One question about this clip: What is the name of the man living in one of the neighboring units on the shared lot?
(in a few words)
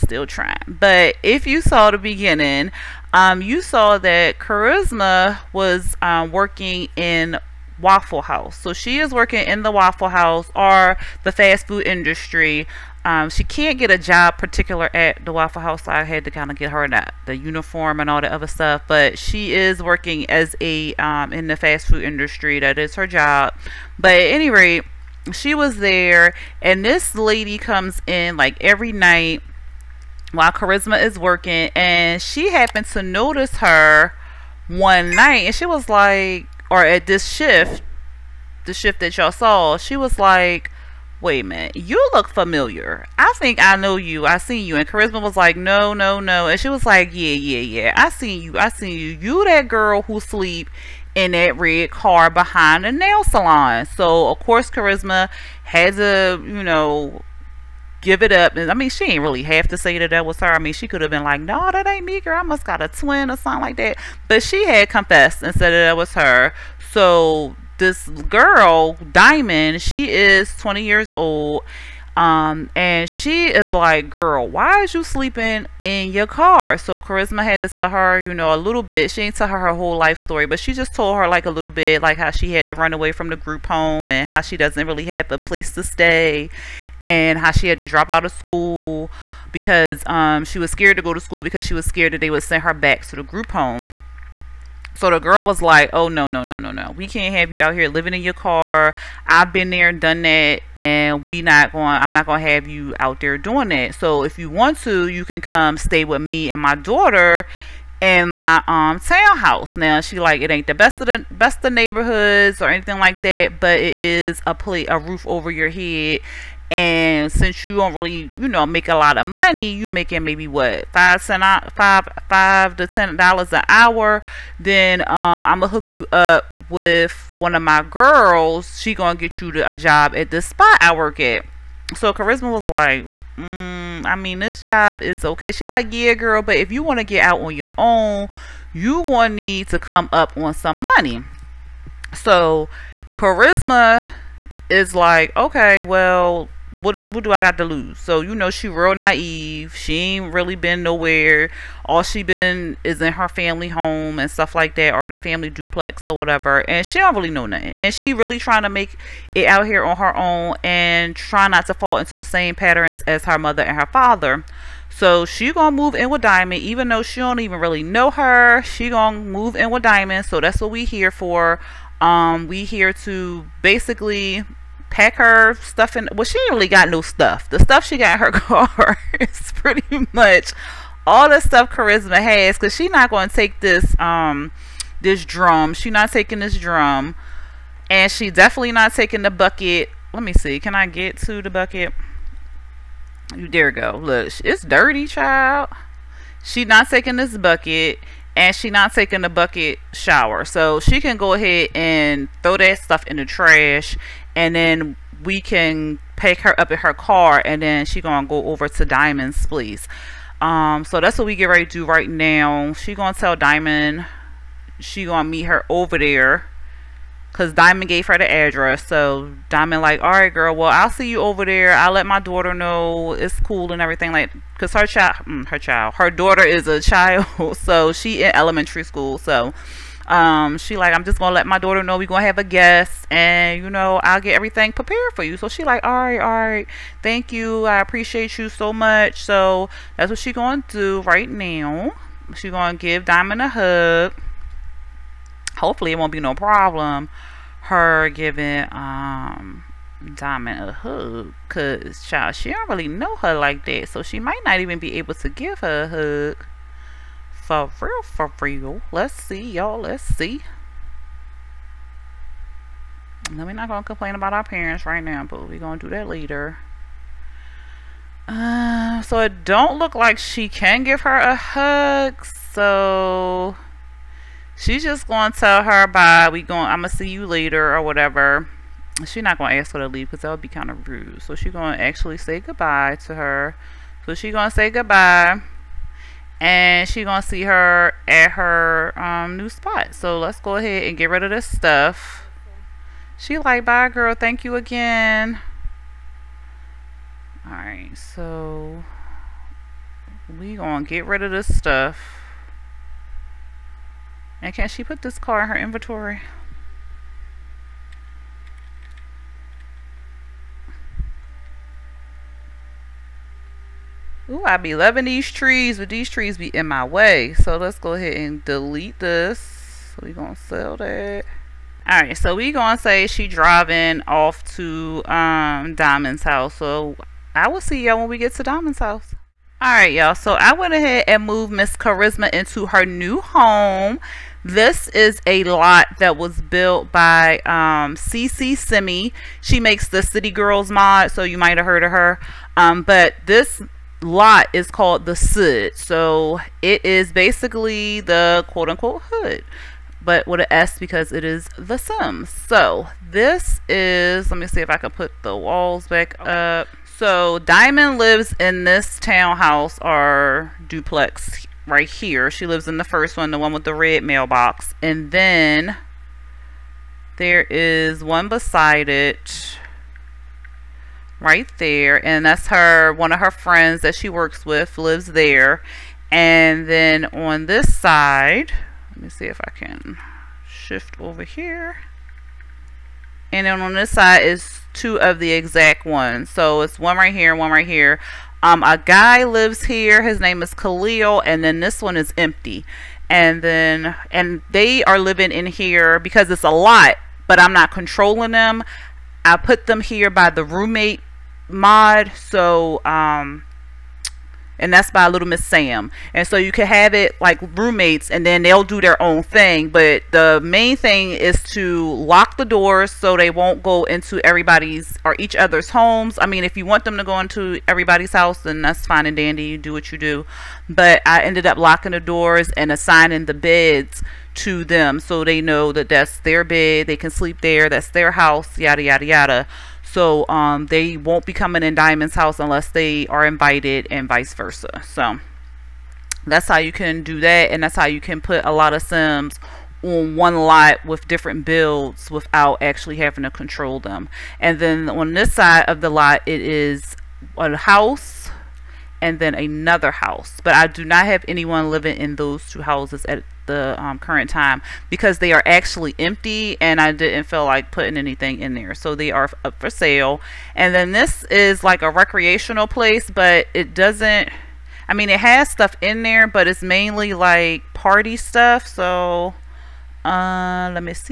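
Khalil.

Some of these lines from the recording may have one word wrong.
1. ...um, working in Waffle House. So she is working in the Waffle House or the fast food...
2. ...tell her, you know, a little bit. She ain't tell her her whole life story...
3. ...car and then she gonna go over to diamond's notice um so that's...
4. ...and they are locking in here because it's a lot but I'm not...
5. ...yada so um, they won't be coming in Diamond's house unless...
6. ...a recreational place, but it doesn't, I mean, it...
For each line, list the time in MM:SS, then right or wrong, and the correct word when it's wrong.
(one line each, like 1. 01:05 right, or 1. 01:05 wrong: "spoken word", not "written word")
1. 00:06 right
2. 01:17 right
3. 03:26 wrong: "place", not "notice"
4. 06:34 wrong: "living", not "locking"
5. 07:09 right
6. 07:41 right.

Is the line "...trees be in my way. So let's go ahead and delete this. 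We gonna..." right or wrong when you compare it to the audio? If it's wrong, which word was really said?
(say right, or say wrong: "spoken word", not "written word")
right.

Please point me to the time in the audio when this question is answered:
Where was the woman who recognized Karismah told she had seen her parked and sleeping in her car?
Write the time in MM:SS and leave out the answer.
00:52.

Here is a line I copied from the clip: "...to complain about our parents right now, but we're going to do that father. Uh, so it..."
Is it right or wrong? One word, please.
wrong.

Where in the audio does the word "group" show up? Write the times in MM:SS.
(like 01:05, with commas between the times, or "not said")
01:23, 01:33.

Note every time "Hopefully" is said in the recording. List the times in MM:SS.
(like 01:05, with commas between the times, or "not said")
04:05.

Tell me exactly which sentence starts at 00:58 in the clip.
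And I mean, she ain't really have to say that that was her.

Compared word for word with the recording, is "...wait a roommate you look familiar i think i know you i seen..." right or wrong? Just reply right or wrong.
wrong.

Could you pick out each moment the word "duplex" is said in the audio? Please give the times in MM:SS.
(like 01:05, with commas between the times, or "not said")
02:35, 06:00.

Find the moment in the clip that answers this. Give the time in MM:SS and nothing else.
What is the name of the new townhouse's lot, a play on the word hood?
05:45.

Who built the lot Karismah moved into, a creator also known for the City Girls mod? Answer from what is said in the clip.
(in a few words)
SeSeSimmi.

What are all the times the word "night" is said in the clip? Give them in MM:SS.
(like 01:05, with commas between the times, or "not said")
00:28, 00:35.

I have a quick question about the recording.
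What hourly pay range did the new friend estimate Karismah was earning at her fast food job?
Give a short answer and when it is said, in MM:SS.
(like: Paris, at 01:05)
$5 to $10, at 02:02.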